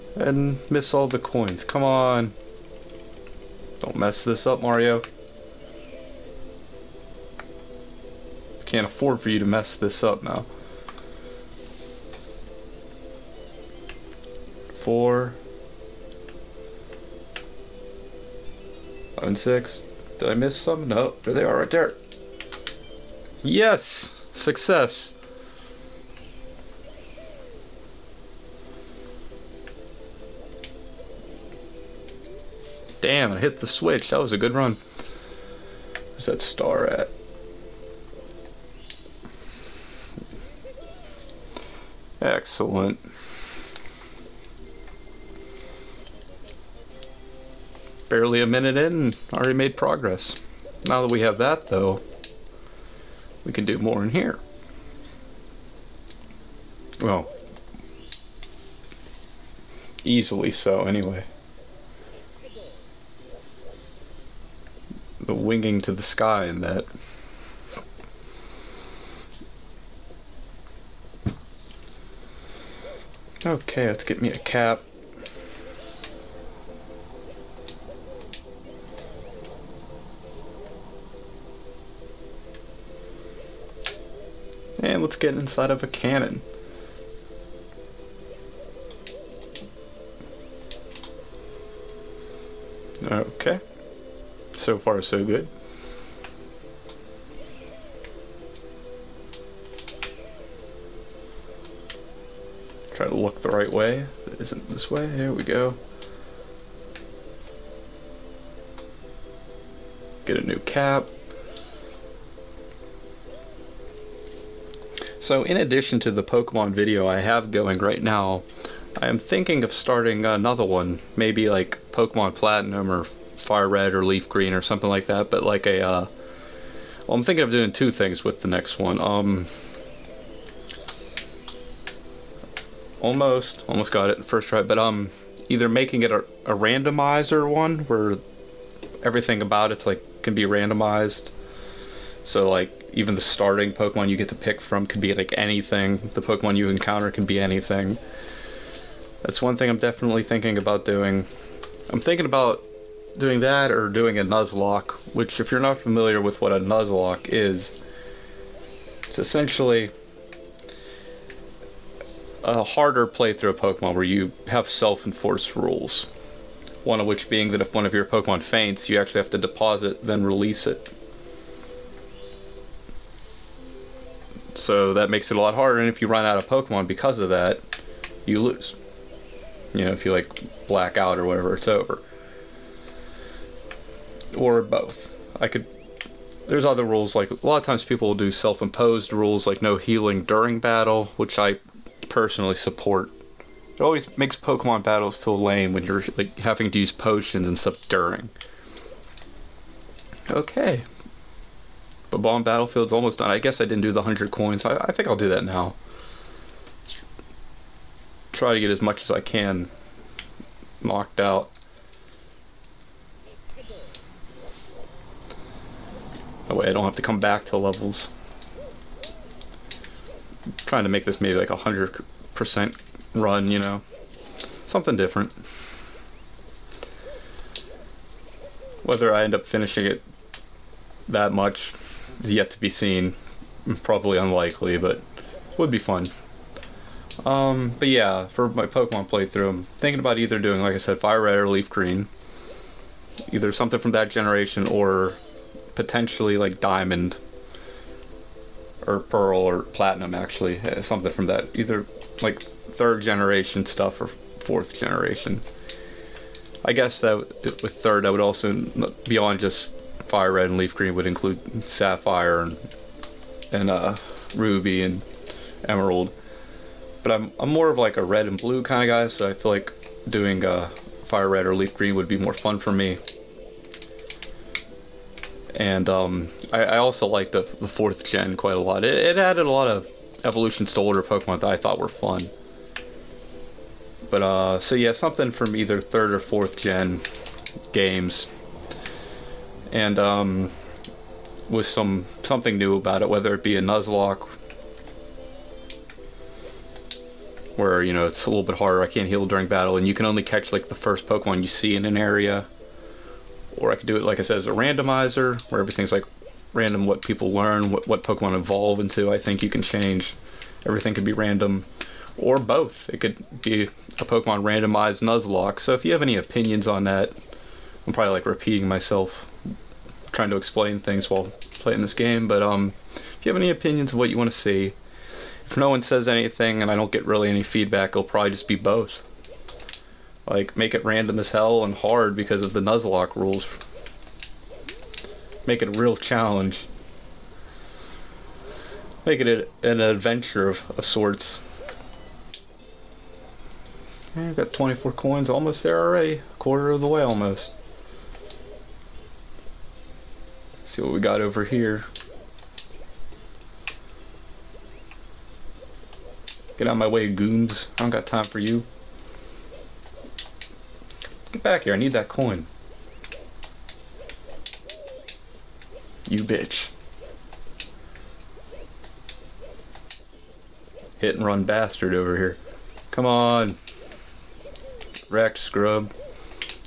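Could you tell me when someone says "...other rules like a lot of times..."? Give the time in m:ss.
3:06.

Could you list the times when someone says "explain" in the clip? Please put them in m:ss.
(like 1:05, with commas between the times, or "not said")
5:20.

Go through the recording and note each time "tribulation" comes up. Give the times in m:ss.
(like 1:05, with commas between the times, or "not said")
not said.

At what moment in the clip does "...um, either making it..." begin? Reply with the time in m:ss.
2:14.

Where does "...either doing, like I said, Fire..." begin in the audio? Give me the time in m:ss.
4:00.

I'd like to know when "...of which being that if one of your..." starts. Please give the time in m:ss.
2:46.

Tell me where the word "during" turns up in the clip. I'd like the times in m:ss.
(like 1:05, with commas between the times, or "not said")
3:10, 3:17, 4:59.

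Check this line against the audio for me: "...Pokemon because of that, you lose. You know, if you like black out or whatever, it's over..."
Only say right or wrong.
right.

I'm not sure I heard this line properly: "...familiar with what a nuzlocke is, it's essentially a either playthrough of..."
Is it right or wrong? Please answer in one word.
wrong.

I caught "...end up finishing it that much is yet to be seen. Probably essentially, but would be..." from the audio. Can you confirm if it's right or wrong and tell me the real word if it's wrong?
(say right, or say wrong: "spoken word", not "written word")
wrong: "unlikely", not "essentially".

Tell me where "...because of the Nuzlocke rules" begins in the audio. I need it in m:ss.
5:32.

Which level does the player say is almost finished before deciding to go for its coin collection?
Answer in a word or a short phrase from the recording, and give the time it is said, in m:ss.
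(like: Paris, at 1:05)
Bomb Battlefield, at 3:22.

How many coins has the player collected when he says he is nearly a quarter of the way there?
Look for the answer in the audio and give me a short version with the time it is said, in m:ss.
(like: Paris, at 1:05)
24, at 5:44.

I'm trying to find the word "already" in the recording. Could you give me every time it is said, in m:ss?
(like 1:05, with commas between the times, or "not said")
0:49, 5:45.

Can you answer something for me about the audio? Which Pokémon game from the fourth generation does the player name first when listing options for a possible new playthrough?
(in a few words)
Pokemon Platinum.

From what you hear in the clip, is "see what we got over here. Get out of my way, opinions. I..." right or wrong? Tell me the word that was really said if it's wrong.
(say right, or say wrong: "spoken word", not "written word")
wrong: "goons", not "opinions".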